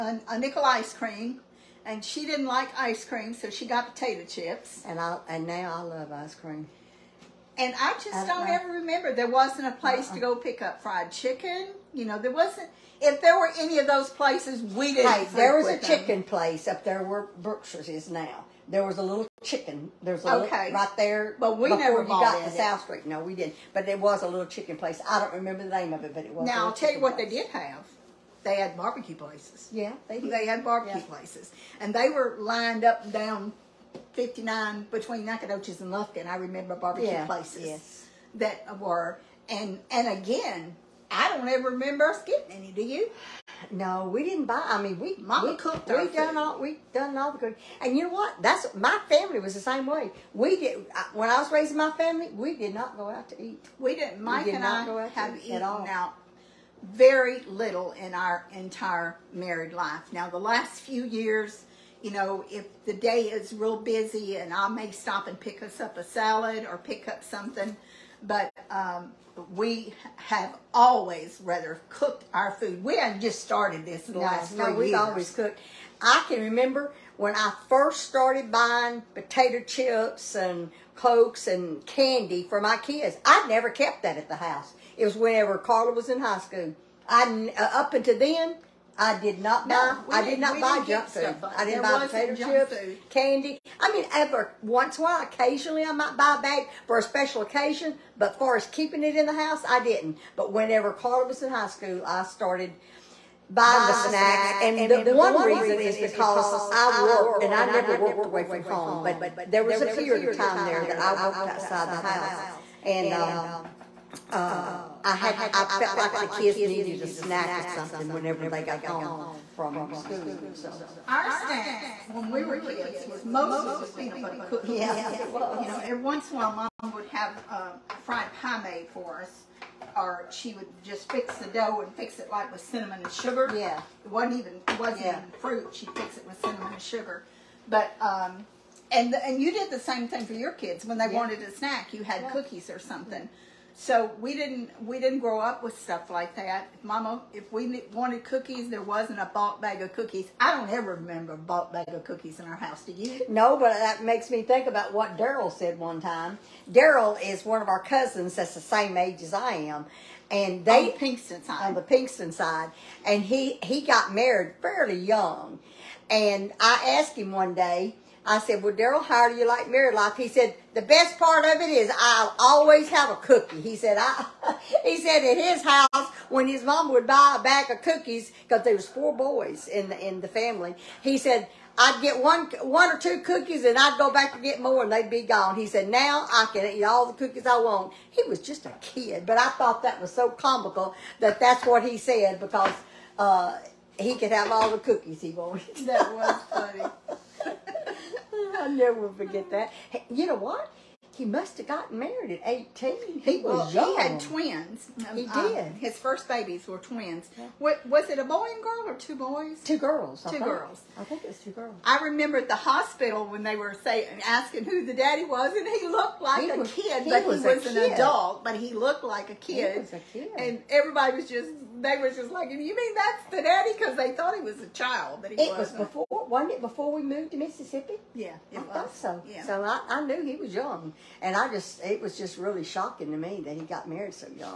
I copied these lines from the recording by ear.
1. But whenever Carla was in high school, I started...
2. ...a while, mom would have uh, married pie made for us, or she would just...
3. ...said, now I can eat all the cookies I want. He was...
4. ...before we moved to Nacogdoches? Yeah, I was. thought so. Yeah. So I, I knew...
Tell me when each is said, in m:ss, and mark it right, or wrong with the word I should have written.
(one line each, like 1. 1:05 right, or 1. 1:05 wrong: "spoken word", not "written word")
1. 1:40 right
2. 2:06 wrong: "fried", not "married"
3. 3:05 right
4. 3:46 wrong: "Mississippi", not "Nacogdoches".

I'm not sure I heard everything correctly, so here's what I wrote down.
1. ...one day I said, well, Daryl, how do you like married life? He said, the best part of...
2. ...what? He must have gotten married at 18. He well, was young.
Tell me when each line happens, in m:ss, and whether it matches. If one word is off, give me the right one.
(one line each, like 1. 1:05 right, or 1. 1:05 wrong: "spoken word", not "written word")
1. 2:47 right
2. 3:20 right.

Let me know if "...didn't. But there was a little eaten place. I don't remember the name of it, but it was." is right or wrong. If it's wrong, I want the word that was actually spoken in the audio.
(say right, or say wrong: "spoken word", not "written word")
wrong: "chicken", not "eaten".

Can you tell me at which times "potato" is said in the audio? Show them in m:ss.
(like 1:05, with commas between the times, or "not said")
0:03, 1:19, 1:32.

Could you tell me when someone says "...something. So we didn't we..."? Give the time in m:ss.
2:22.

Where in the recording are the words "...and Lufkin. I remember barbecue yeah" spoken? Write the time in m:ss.
0:35.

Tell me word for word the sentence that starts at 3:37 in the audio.
adult, but he looked like a kid.